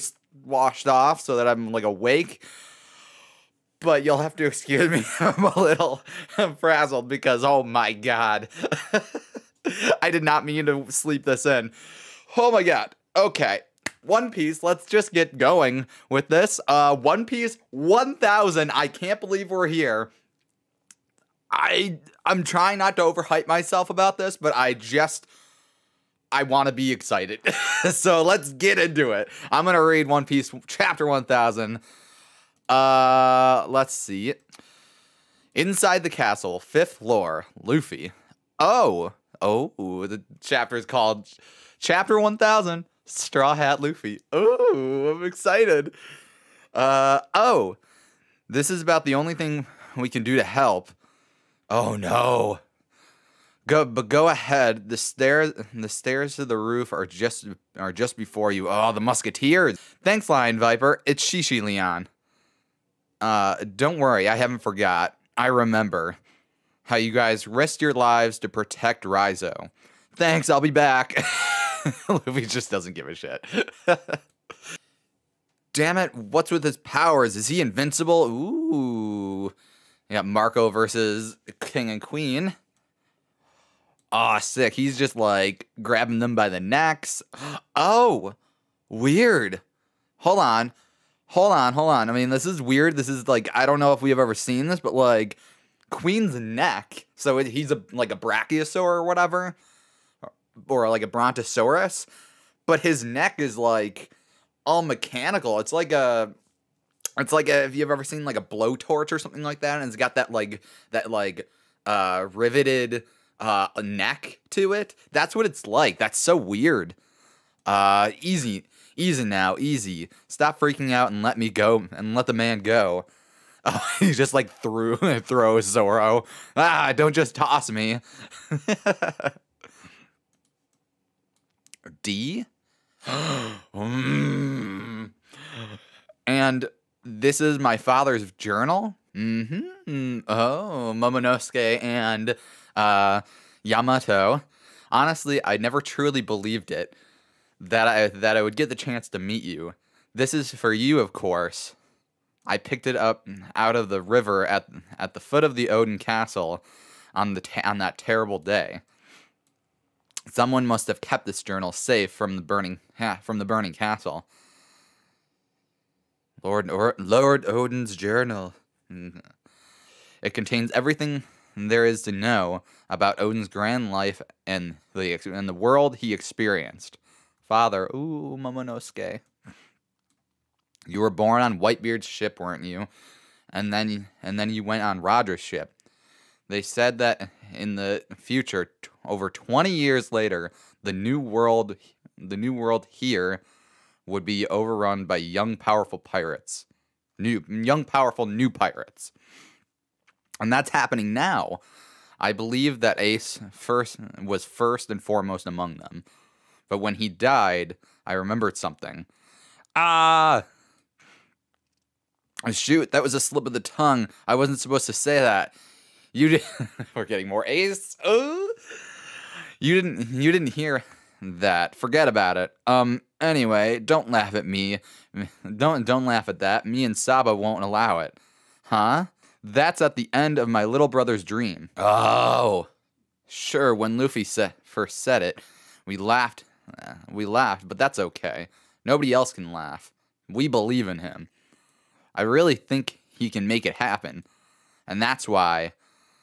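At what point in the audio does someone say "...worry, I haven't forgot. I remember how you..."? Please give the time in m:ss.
1:03.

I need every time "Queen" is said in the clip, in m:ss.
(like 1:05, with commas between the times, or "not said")
1:22, 1:35.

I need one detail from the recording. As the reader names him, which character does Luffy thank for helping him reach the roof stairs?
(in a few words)
Lion Viper.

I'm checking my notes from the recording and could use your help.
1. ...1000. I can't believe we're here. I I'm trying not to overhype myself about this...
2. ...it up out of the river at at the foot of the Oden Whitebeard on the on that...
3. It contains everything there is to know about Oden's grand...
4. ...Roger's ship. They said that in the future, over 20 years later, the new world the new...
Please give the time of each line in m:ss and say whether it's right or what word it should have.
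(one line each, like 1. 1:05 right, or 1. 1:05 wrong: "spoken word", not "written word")
1. 0:17 right
2. 2:32 wrong: "Castle", not "Whitebeard"
3. 2:50 right
4. 3:05 right.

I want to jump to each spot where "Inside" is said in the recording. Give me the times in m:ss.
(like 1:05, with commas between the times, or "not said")
0:35.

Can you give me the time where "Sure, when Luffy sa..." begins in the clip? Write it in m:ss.
3:53.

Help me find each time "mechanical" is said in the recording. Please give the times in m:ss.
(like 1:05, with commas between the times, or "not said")
1:44.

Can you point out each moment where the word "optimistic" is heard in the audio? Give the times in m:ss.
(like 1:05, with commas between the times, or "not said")
not said.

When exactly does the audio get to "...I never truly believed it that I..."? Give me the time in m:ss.
2:25.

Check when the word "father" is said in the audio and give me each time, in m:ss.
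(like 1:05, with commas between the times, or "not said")
2:17, 2:57.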